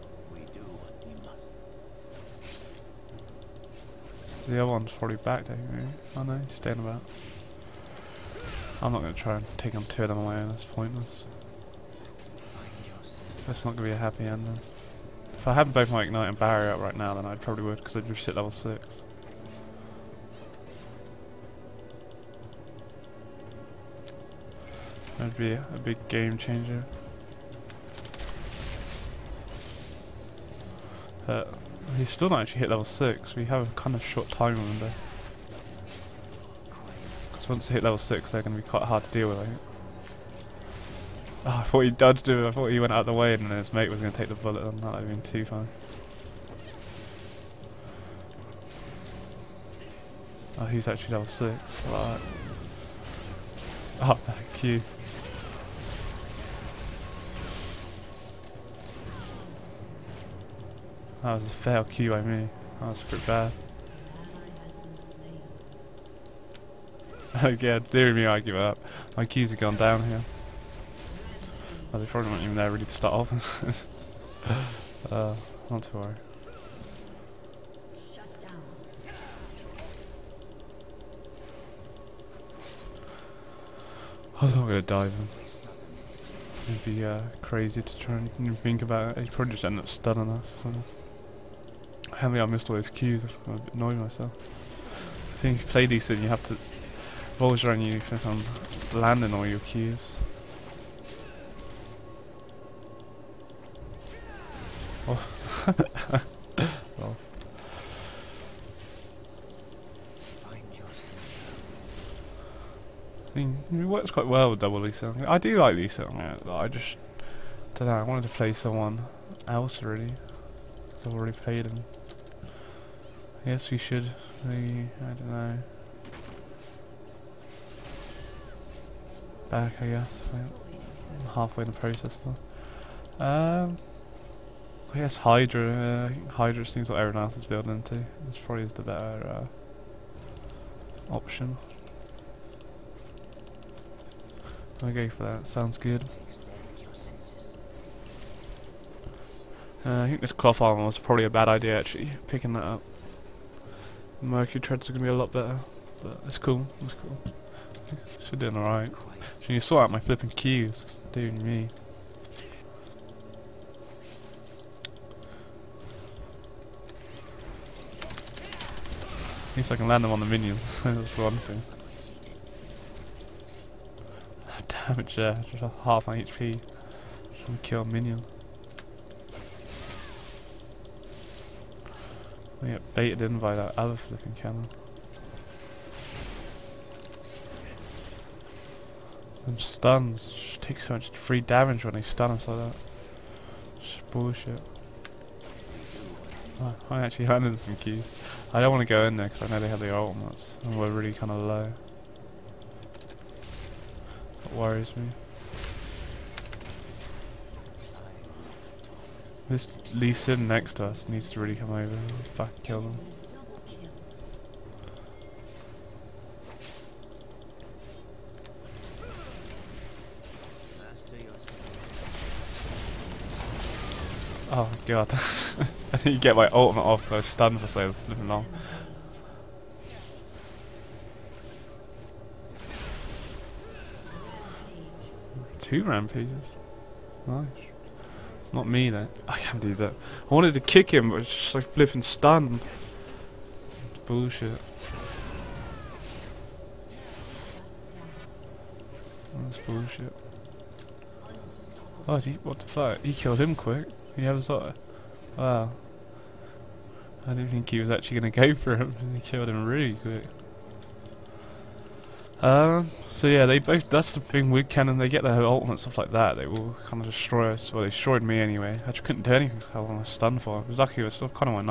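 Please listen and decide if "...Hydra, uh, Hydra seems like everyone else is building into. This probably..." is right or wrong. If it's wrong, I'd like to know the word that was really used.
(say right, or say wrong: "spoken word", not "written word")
right.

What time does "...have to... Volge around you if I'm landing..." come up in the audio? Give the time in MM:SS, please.
01:36.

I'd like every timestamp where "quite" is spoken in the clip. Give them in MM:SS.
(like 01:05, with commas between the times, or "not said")
00:38, 01:54.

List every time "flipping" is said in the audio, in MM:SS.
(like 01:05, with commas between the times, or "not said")
02:39, 03:03, 04:01.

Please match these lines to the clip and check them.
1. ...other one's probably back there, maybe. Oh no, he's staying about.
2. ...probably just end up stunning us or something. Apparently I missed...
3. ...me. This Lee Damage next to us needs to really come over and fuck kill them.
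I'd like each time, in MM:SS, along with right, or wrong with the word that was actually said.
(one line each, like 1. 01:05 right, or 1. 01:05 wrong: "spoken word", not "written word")
1. 00:04 right
2. 01:29 right
3. 03:24 wrong: "Sin", not "Damage".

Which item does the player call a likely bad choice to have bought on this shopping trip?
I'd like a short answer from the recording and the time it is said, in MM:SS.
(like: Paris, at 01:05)
Cloth armor, at 02:30.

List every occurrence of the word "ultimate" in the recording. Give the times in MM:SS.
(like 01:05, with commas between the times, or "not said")
03:19, 03:46, 04:25.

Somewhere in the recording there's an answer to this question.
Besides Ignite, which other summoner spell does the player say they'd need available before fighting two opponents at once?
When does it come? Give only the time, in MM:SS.
00:16.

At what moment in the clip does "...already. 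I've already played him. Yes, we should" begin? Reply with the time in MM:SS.
01:59.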